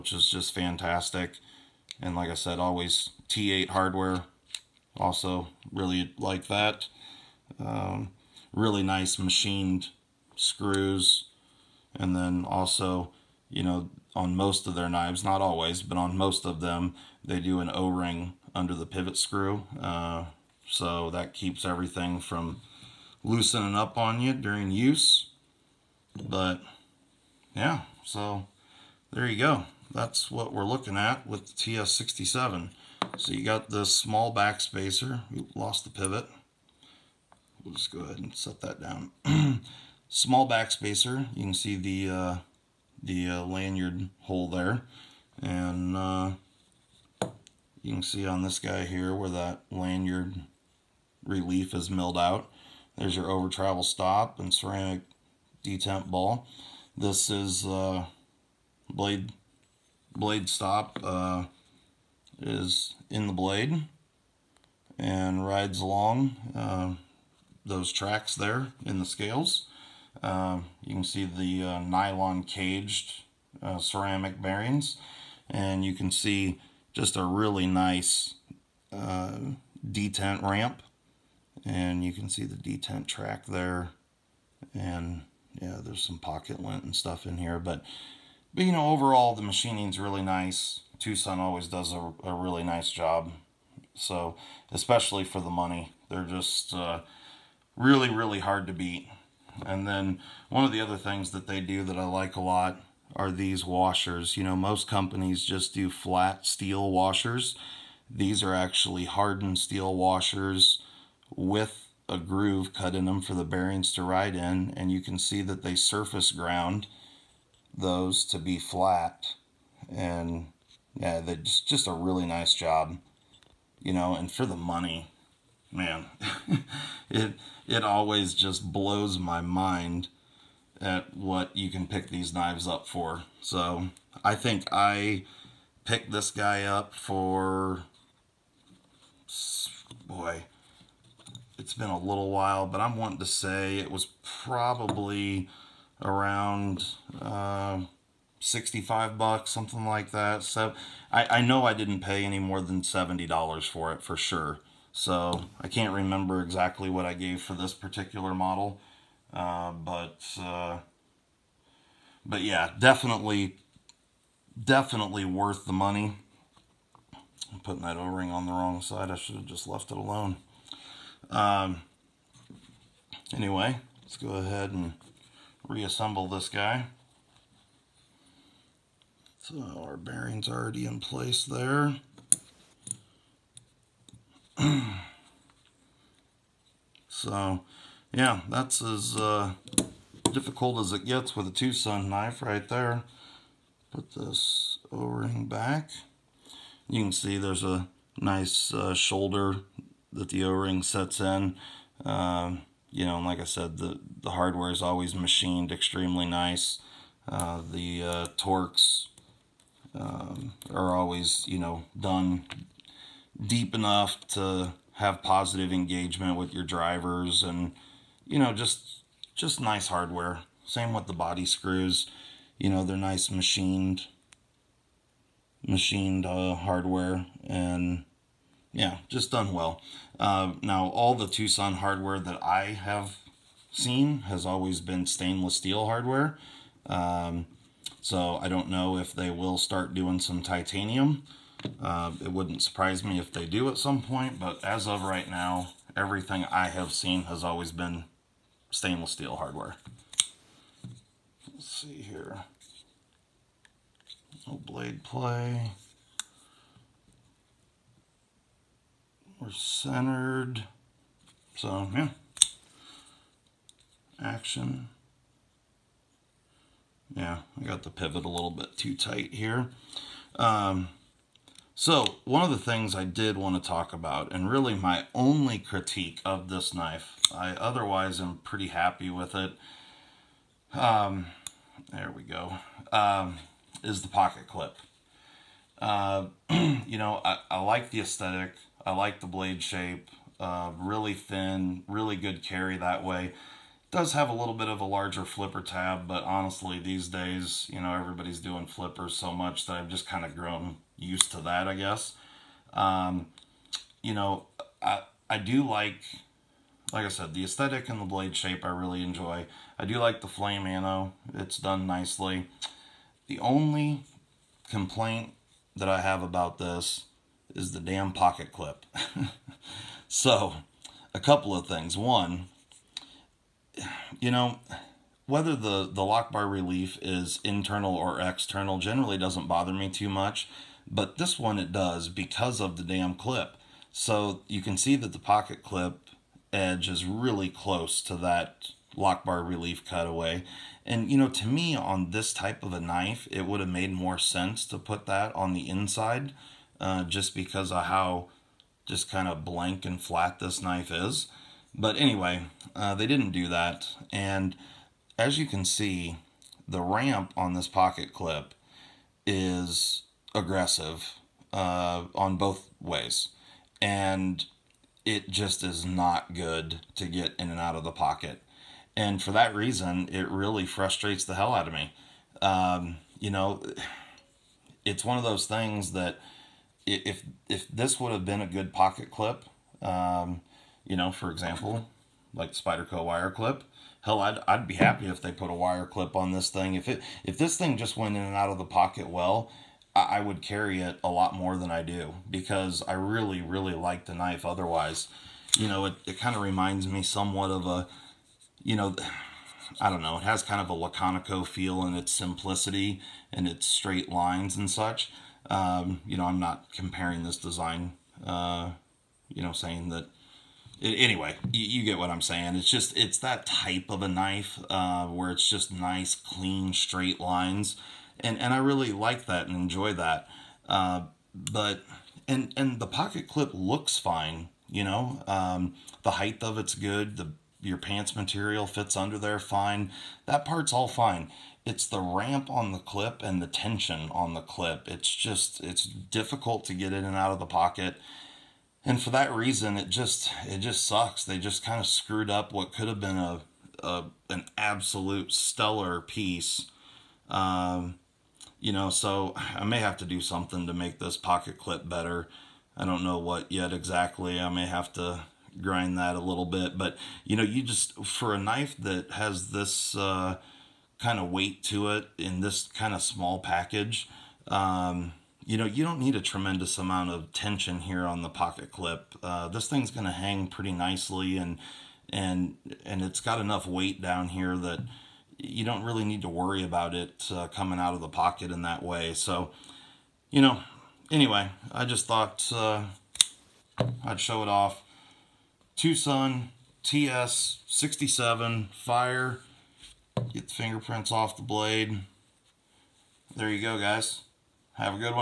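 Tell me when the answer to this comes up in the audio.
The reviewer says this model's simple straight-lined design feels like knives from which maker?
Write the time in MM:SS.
06:40.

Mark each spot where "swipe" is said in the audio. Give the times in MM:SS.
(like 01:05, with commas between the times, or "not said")
not said.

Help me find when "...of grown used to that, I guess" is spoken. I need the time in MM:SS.
05:00.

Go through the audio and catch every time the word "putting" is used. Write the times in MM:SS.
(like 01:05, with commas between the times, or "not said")
02:47.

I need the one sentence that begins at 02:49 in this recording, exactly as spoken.
I should have just left it alone.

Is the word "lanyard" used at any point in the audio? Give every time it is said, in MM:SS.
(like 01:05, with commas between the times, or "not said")
00:43, 00:49.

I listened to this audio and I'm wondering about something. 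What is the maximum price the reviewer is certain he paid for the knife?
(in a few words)
$70.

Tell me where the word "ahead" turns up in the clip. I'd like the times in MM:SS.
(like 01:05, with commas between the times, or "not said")
00:37, 02:54.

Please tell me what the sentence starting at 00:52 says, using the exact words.
There's your over travel stop and ceramic detent ball.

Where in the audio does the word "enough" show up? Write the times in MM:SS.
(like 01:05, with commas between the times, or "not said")
03:33, 07:53.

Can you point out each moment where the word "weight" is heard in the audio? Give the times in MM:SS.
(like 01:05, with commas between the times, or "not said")
07:41, 07:53.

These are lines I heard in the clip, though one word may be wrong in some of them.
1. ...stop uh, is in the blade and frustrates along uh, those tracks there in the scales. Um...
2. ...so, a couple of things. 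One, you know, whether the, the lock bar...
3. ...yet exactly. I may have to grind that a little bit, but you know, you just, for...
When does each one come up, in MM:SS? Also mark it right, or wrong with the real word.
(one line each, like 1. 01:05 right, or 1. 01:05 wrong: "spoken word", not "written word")
1. 01:00 wrong: "rides", not "frustrates"
2. 05:20 right
3. 07:33 right.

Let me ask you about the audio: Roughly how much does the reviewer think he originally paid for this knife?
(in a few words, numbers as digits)
$65.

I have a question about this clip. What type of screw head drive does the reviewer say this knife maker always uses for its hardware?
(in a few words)
T8.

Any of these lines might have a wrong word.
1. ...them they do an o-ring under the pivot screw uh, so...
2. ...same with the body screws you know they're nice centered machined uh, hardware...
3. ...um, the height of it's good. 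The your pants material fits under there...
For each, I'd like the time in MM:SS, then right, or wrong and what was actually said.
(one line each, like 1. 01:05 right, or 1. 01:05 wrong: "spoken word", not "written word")
1. 00:16 right
2. 03:40 wrong: "machined", not "centered"
3. 07:05 right.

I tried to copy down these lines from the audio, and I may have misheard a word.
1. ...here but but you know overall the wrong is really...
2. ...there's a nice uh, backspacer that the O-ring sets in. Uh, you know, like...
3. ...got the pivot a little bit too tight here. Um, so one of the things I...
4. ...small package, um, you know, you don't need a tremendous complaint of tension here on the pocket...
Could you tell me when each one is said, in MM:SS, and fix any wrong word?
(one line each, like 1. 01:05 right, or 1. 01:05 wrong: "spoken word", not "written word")
1. 01:27 wrong: "machining", not "wrong"
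2. 03:17 wrong: "shoulder", not "backspacer"
3. 04:27 right
4. 07:43 wrong: "amount", not "complaint".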